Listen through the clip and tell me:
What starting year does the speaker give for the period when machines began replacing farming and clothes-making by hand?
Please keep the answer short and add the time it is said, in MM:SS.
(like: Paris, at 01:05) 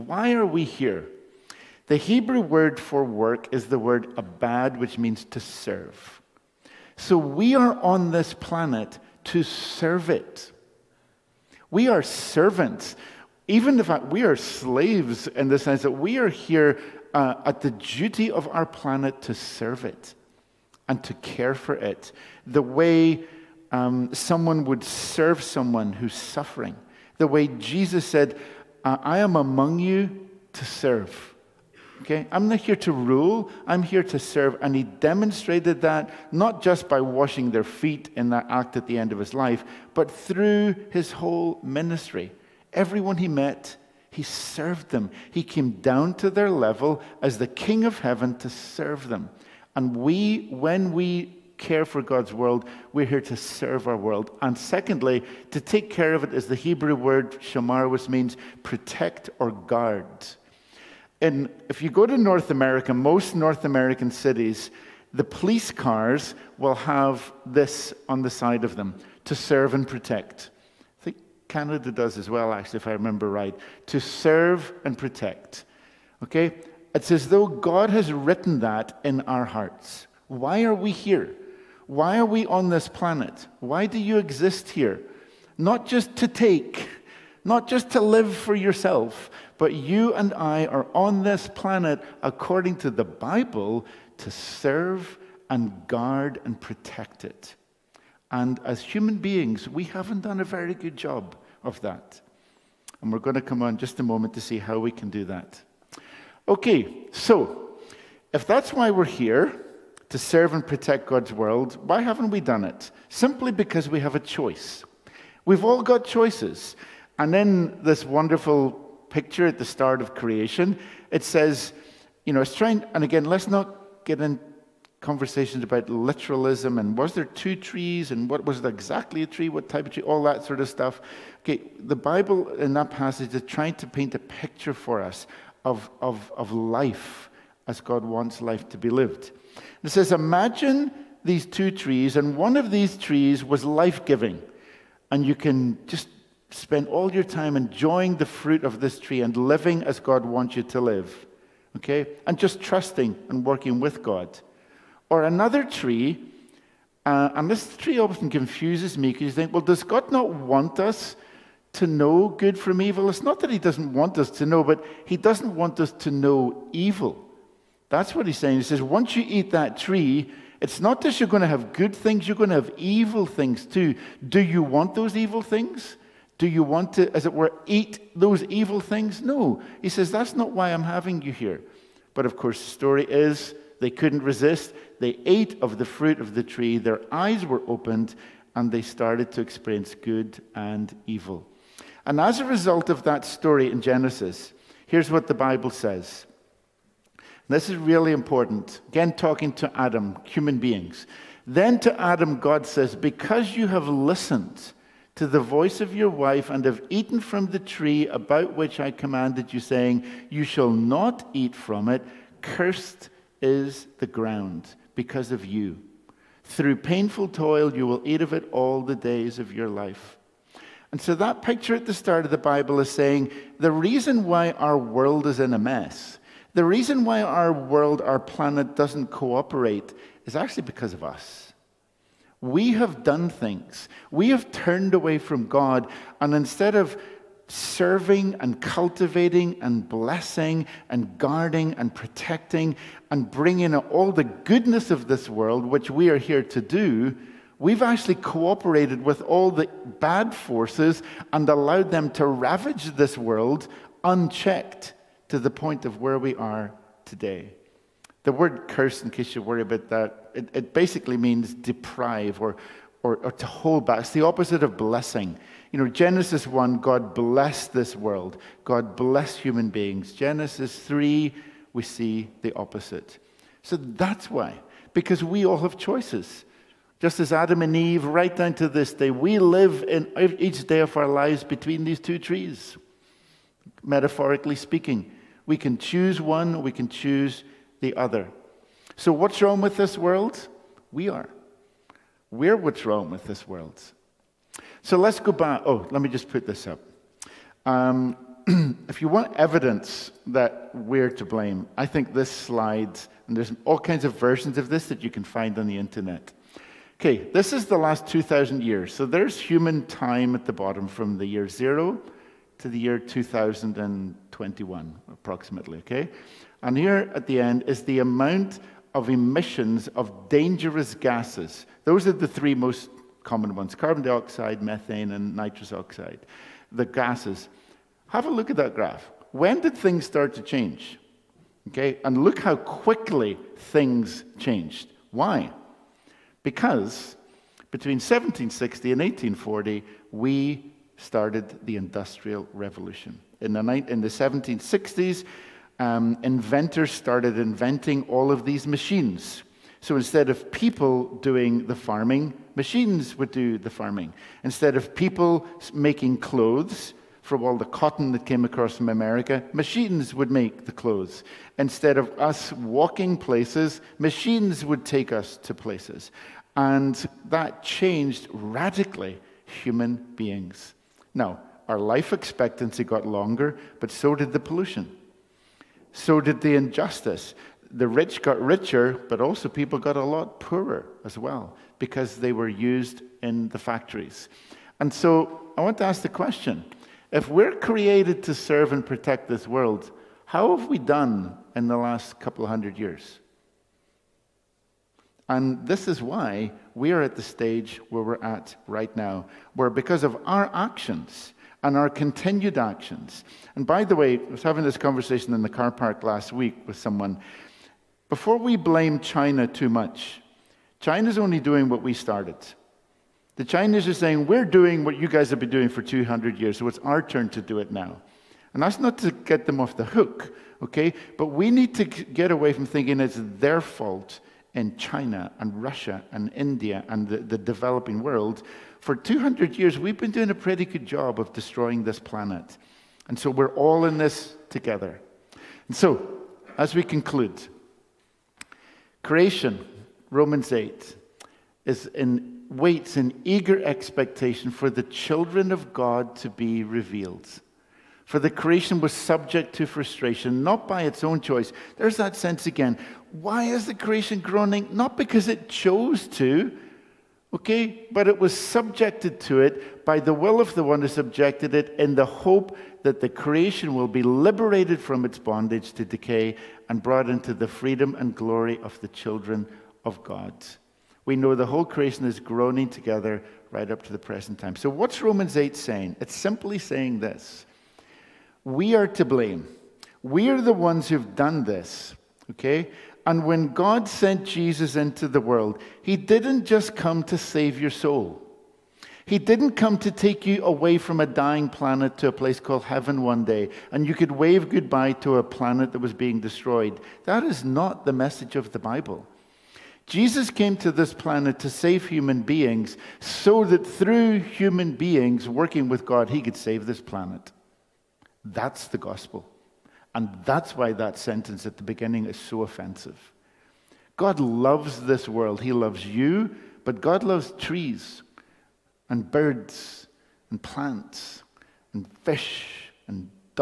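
1760, at 05:37.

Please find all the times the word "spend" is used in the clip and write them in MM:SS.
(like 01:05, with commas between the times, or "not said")
02:26.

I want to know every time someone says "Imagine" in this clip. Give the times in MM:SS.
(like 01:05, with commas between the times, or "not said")
02:20.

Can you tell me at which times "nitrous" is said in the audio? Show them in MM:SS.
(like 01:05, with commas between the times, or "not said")
05:25.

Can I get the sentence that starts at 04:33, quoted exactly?
So that's why, because we all have choices.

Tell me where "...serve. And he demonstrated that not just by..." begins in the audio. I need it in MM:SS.
00:34.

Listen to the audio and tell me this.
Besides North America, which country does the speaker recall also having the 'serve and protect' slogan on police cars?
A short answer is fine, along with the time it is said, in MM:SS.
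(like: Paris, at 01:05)
Canada, at 01:11.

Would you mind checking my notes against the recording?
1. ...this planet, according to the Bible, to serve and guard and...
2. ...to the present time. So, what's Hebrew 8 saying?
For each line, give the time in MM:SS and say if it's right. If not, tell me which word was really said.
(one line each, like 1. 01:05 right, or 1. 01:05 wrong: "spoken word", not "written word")
1. 01:31 right
2. 07:53 wrong: "Romans", not "Hebrew".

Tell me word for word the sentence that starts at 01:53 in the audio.
Simply because we have a choice.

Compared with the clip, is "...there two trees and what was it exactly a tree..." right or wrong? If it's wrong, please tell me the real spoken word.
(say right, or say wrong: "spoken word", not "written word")
right.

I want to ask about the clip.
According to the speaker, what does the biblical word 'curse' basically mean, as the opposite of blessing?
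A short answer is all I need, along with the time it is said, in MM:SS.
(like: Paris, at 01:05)
deprive, at 04:21.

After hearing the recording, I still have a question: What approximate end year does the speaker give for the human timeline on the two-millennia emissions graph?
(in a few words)
2021.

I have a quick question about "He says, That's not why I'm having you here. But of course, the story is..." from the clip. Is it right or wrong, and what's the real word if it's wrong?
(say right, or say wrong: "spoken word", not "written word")
right.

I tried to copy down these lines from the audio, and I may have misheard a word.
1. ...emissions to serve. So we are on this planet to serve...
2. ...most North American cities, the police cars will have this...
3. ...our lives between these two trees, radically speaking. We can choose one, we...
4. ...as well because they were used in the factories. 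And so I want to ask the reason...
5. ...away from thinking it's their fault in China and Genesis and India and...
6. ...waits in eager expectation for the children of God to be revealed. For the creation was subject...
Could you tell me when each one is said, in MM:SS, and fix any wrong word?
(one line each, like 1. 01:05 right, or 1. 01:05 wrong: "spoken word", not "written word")
1. 00:04 wrong: "means", not "emissions"
2. 01:02 right
3. 04:40 wrong: "metaphorically", not "radically"
4. 06:21 wrong: "question", not "reason"
5. 07:02 wrong: "Russia", not "Genesis"
6. 07:22 right.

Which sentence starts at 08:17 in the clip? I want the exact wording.
That is not the message of the Bible.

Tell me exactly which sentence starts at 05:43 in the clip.
In the, in the 1760s, um, inventors started inventing all of these machines.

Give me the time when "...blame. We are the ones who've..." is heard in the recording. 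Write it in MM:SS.
07:59.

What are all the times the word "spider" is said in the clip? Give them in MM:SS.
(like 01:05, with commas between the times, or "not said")
not said.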